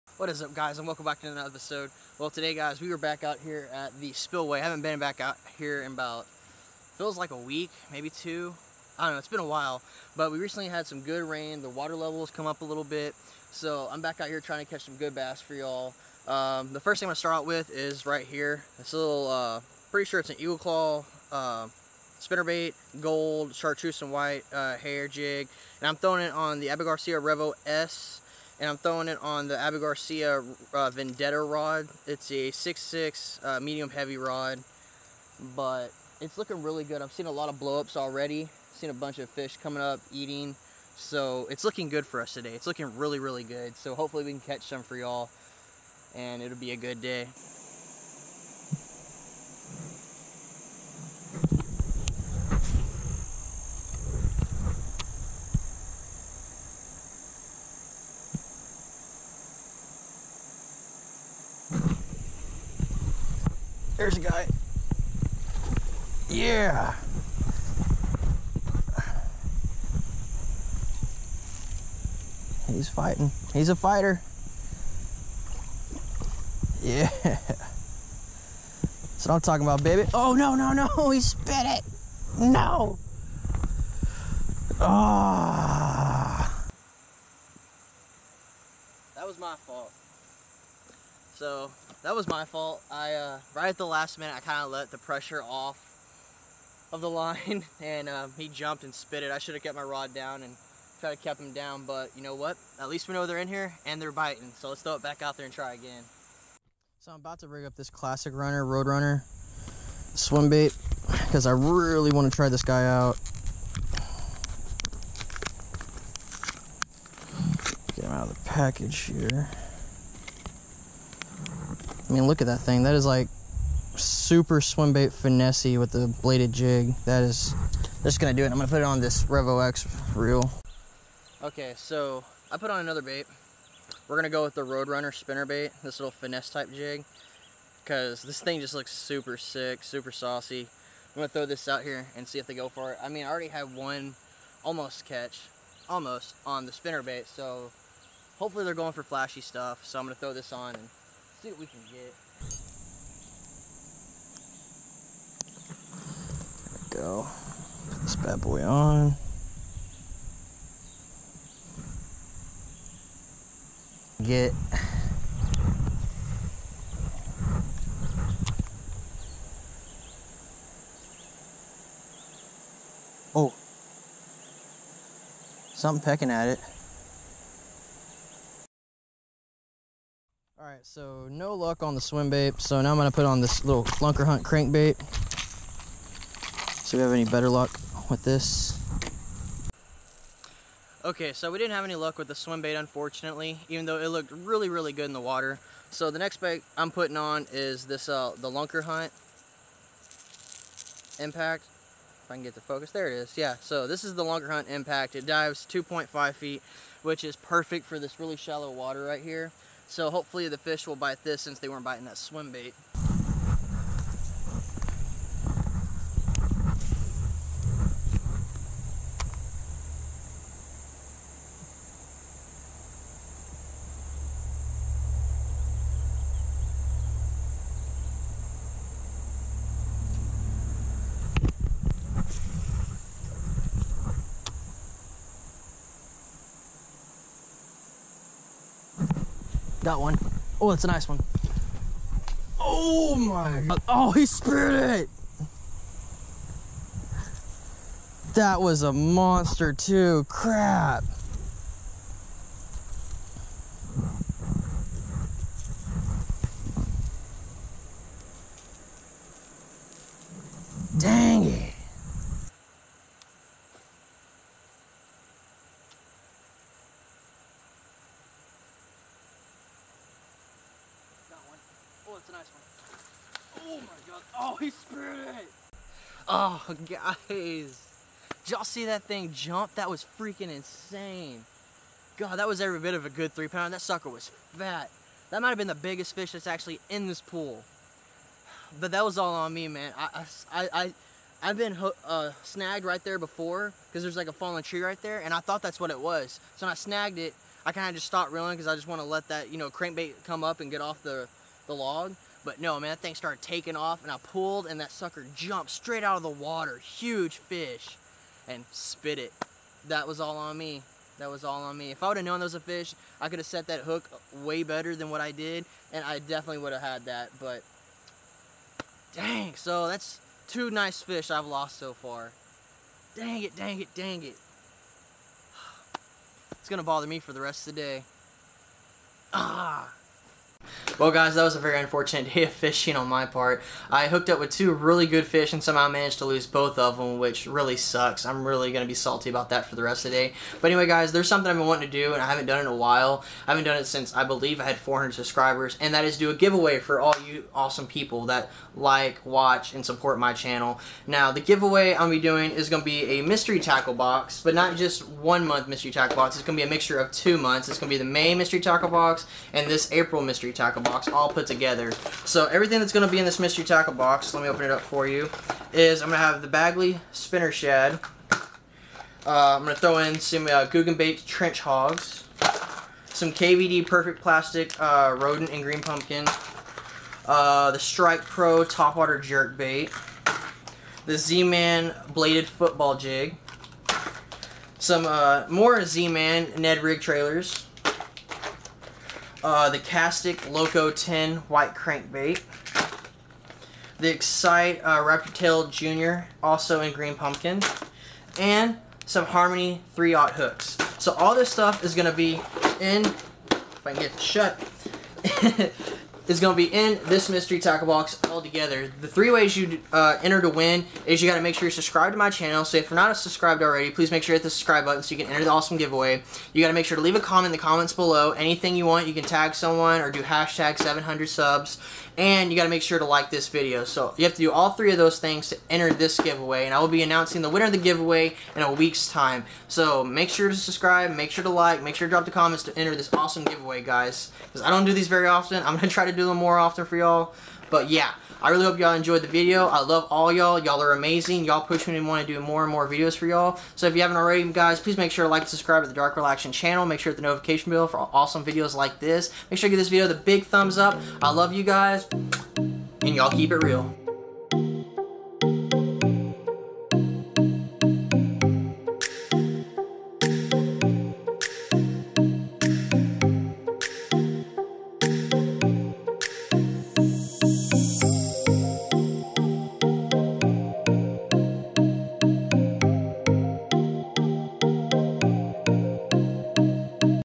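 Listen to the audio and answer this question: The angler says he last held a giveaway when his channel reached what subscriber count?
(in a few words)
400.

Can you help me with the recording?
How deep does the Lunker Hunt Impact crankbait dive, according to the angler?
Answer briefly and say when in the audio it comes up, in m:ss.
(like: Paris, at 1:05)
2.5 feet, at 3:25.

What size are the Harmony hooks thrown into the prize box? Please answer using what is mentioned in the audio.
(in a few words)
3-aught.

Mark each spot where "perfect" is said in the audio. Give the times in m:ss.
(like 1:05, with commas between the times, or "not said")
3:27, 6:13.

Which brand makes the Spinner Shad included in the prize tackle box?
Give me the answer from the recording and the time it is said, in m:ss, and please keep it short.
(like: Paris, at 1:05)
Bagley, at 6:06.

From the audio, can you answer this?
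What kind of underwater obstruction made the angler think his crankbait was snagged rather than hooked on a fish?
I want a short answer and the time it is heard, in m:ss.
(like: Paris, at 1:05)
a fallen tree, at 4:54.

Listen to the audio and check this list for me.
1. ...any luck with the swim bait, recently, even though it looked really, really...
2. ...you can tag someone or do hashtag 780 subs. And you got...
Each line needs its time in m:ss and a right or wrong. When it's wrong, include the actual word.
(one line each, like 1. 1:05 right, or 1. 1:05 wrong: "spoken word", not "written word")
1. 3:11 wrong: "unfortunately", not "recently"
2. 6:59 wrong: "700", not "780".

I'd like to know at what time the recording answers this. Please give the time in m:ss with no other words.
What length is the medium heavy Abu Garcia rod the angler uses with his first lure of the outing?
0:32.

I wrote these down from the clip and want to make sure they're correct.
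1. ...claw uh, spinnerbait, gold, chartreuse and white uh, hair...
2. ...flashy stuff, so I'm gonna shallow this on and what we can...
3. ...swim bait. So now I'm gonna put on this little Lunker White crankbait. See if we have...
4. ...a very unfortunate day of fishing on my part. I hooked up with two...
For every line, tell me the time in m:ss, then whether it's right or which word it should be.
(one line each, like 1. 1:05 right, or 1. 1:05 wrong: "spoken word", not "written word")
1. 0:20 right
2. 2:29 wrong: "throw", not "shallow"
3. 3:02 wrong: "Hunt", not "White"
4. 5:31 right.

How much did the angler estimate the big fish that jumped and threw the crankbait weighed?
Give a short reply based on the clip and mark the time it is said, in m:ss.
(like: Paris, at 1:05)
3 pounds, at 4:43.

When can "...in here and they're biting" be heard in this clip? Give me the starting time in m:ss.
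1:43.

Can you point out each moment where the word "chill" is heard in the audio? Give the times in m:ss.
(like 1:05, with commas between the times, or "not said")
not said.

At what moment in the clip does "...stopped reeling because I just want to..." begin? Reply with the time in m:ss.
4:58.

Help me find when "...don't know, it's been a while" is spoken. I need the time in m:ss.
0:09.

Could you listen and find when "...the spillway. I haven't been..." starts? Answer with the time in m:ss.
0:03.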